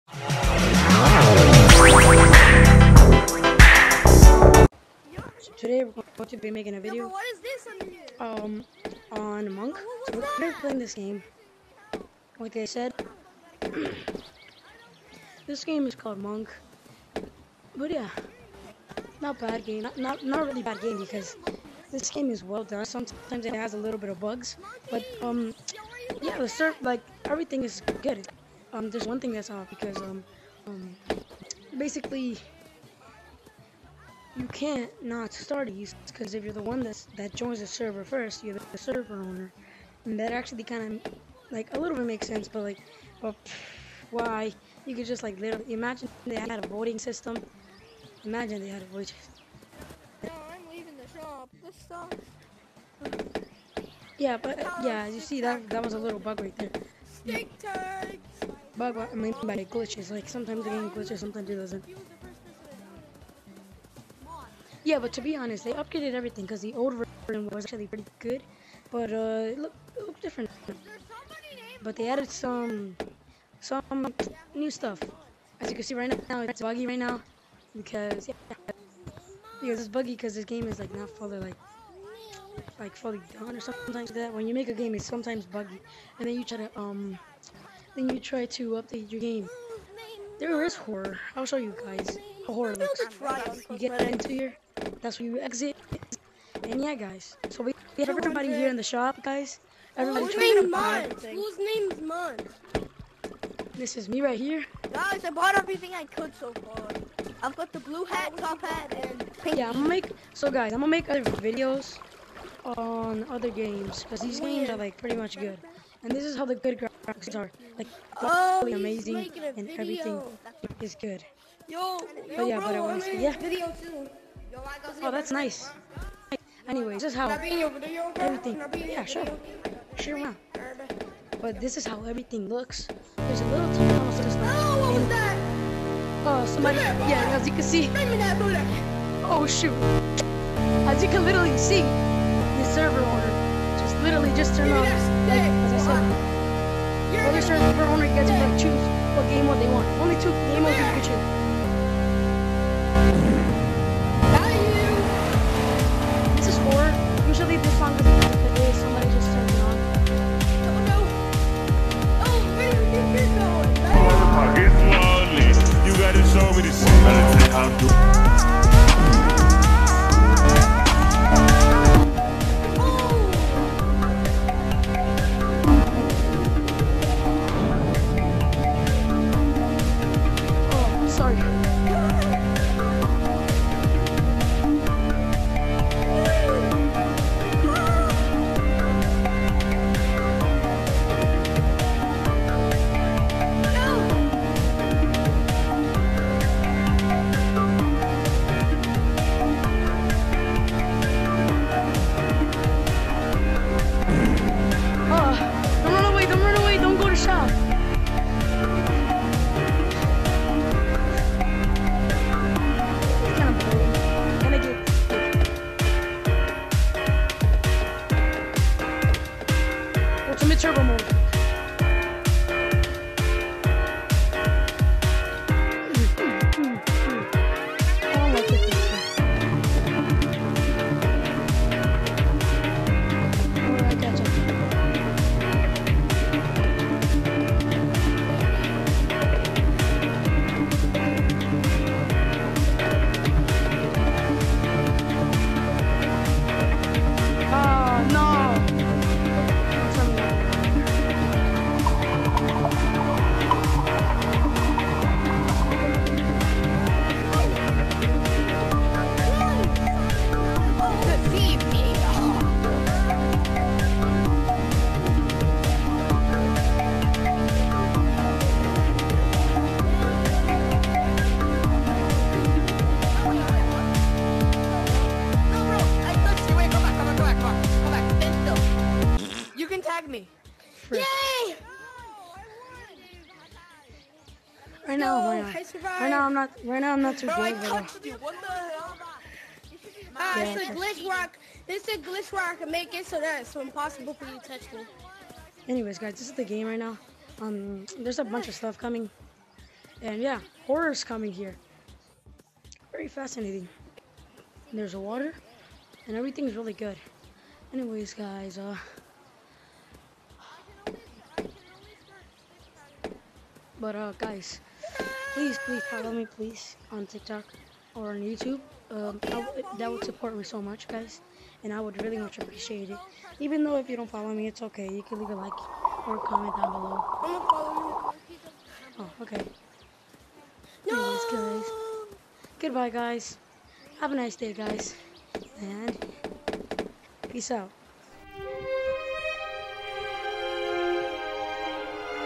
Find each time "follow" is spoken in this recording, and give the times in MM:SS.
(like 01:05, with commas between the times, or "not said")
05:15, 05:24.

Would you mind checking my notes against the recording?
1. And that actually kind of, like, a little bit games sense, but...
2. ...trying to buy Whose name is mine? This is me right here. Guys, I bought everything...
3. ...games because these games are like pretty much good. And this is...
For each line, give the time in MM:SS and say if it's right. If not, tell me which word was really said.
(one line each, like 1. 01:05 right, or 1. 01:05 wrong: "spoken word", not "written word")
1. 00:40 wrong: "makes", not "games"
2. 01:40 right
3. 01:53 right.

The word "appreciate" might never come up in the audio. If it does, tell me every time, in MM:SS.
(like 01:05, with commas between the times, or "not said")
05:22.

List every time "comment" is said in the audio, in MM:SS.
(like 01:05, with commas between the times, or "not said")
05:26.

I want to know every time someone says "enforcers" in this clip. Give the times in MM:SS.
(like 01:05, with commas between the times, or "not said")
not said.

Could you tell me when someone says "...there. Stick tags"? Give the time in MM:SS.
00:56.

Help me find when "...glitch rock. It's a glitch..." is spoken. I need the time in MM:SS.
04:50.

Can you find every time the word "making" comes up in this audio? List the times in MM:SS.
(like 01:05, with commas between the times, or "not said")
00:06, 02:02.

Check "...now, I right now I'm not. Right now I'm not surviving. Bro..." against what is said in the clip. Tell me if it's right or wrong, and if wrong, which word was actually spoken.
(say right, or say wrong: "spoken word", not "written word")
right.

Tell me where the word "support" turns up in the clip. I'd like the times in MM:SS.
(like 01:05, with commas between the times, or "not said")
05:20.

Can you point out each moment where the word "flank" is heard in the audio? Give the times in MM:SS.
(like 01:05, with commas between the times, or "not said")
not said.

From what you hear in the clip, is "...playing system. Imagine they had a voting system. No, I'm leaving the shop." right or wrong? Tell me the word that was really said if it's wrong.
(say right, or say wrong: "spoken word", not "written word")
wrong: "voting", not "playing".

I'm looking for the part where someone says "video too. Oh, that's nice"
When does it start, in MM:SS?
02:03.